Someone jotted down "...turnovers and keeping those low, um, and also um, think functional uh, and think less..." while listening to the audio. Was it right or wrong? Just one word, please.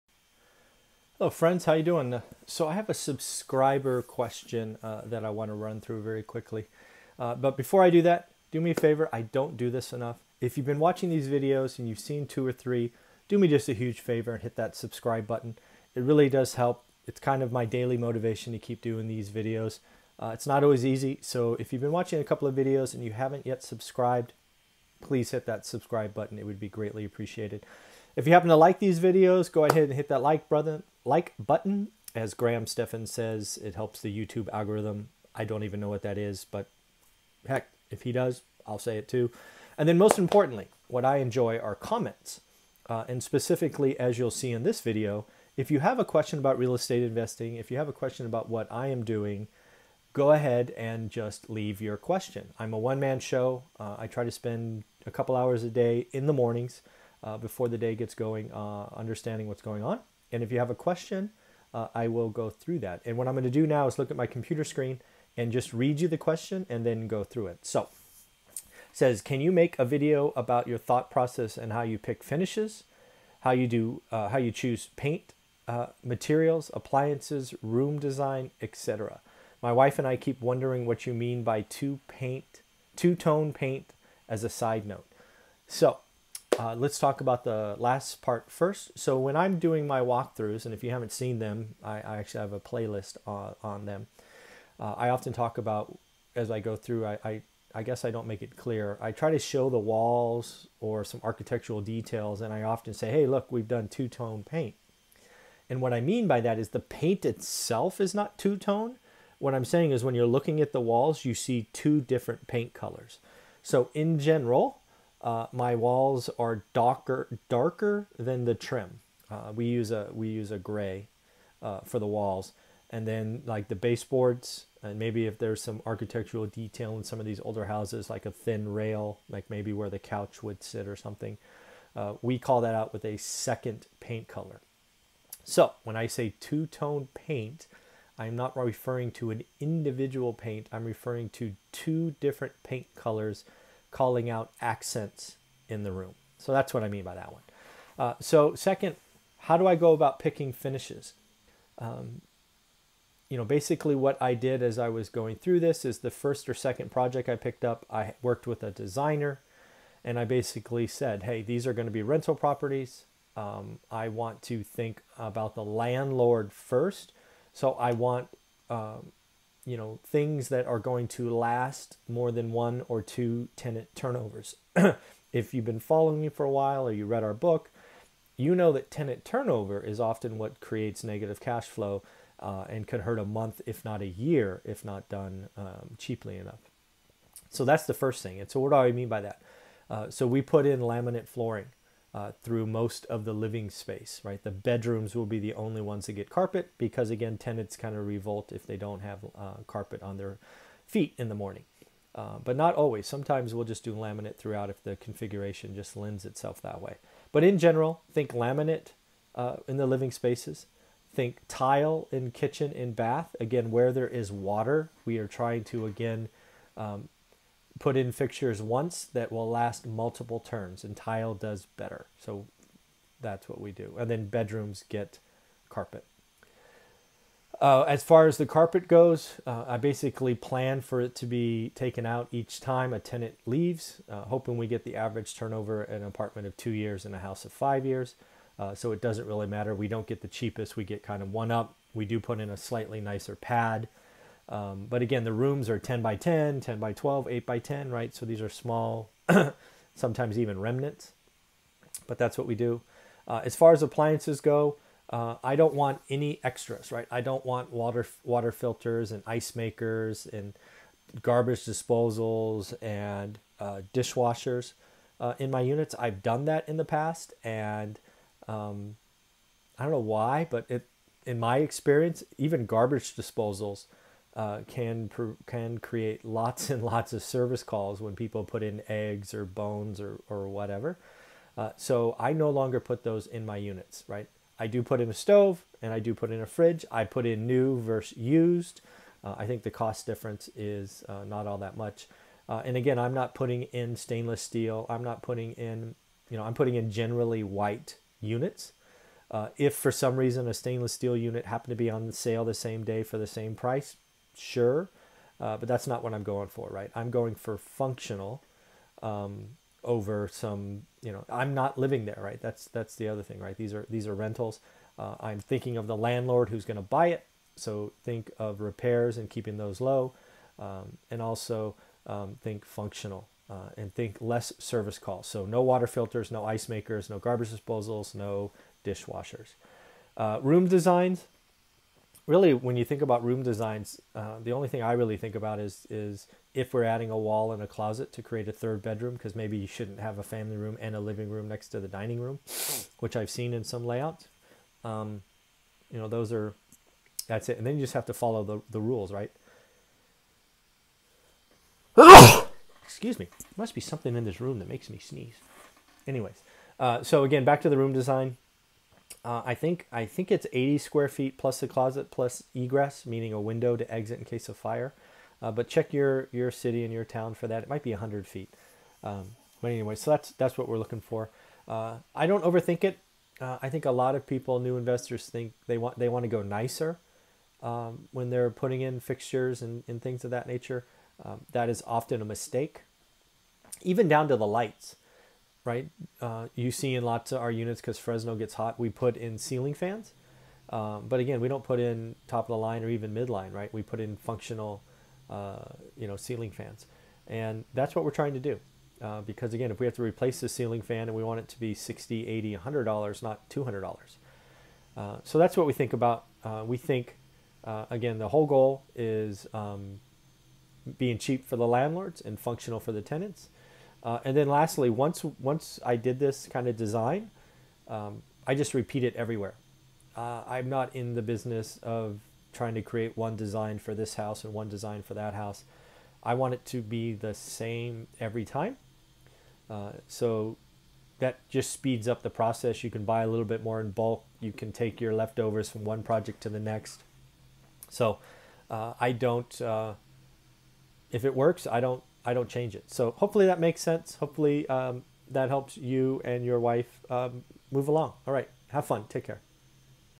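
wrong.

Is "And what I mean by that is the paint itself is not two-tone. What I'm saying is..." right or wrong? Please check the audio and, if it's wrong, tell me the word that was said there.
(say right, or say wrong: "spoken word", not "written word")
right.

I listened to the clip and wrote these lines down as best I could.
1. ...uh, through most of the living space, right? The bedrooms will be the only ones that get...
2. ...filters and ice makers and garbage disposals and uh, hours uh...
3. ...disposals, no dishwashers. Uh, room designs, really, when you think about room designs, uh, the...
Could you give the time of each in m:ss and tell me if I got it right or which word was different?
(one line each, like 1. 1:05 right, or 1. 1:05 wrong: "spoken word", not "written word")
1. 3:12 right
2. 4:18 wrong: "dishwashers", not "hours"
3. 5:27 right.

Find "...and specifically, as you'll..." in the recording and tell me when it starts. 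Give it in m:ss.
0:43.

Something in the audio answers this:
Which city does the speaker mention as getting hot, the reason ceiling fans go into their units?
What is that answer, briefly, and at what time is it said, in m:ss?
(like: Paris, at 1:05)
Fresno, at 6:27.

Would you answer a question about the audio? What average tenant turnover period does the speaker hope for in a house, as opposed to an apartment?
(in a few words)
5 years.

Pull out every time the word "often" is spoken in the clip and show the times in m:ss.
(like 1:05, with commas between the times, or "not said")
1:35, 1:42, 2:59, 6:21.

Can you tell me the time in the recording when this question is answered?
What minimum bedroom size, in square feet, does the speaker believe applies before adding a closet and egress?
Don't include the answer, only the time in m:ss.
6:00.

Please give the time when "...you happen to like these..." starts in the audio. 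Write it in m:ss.
0:28.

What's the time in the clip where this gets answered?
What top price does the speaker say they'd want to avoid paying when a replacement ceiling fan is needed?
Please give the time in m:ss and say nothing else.
6:43.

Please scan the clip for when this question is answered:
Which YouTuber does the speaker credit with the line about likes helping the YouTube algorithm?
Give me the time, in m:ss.
0:32.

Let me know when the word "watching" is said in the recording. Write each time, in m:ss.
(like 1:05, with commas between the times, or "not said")
0:10, 0:21.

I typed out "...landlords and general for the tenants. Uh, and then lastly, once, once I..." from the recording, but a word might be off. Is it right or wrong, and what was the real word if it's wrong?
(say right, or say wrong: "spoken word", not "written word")
wrong: "functional", not "general".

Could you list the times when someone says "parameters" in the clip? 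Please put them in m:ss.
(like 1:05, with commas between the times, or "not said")
not said.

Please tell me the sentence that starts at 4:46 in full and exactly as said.
I put in new versus used.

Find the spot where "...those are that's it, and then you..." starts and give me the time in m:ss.
5:46.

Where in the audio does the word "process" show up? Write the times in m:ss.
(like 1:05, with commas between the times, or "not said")
1:11, 7:12.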